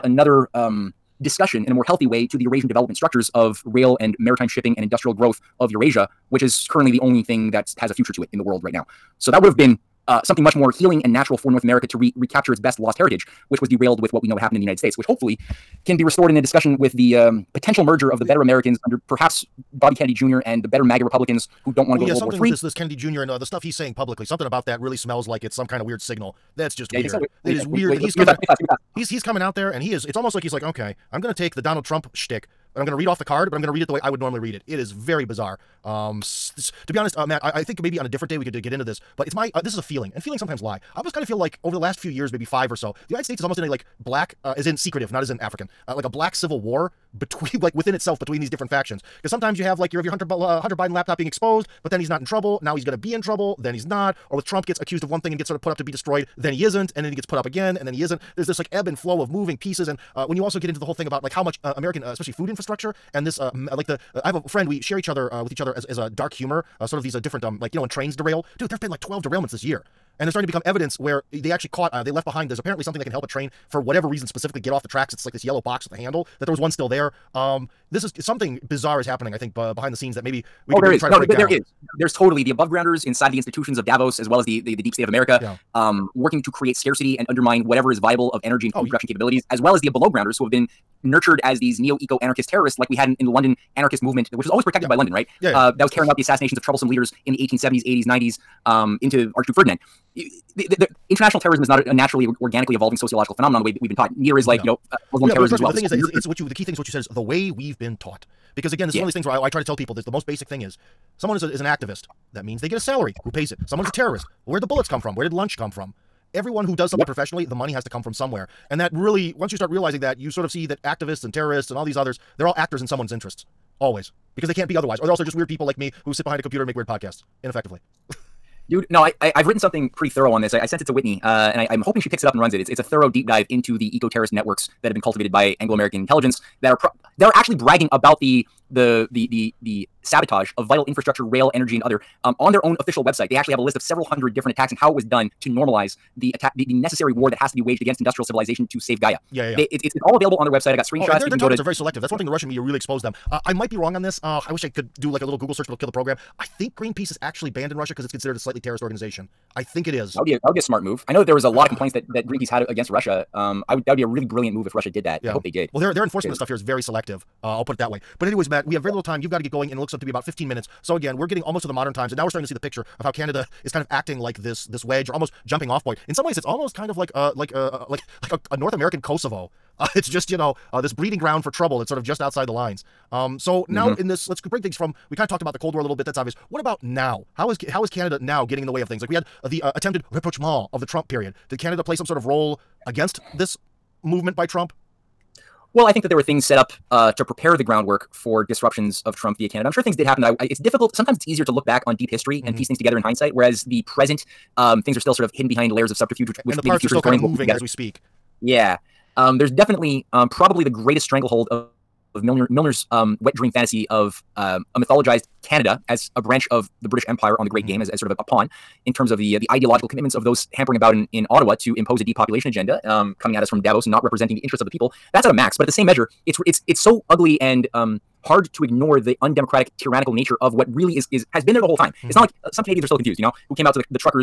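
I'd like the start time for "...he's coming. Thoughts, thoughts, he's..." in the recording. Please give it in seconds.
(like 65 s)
28 s.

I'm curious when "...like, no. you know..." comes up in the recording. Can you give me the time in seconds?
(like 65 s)
104 s.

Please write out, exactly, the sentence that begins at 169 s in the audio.
You've got to get going, and it looks up to be about 15 minutes.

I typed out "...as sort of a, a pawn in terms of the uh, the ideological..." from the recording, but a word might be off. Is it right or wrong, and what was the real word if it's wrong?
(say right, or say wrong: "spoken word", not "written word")
right.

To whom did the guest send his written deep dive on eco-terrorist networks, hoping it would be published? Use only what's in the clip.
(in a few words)
Whitney.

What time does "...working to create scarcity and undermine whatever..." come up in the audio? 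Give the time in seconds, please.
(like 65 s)
86 s.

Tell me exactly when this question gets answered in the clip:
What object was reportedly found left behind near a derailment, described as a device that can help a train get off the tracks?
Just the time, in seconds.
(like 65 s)
75 s.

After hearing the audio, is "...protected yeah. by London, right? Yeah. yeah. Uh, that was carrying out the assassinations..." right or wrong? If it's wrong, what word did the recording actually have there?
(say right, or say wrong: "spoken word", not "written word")
right.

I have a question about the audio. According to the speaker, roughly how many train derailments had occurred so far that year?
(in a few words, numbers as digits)
12.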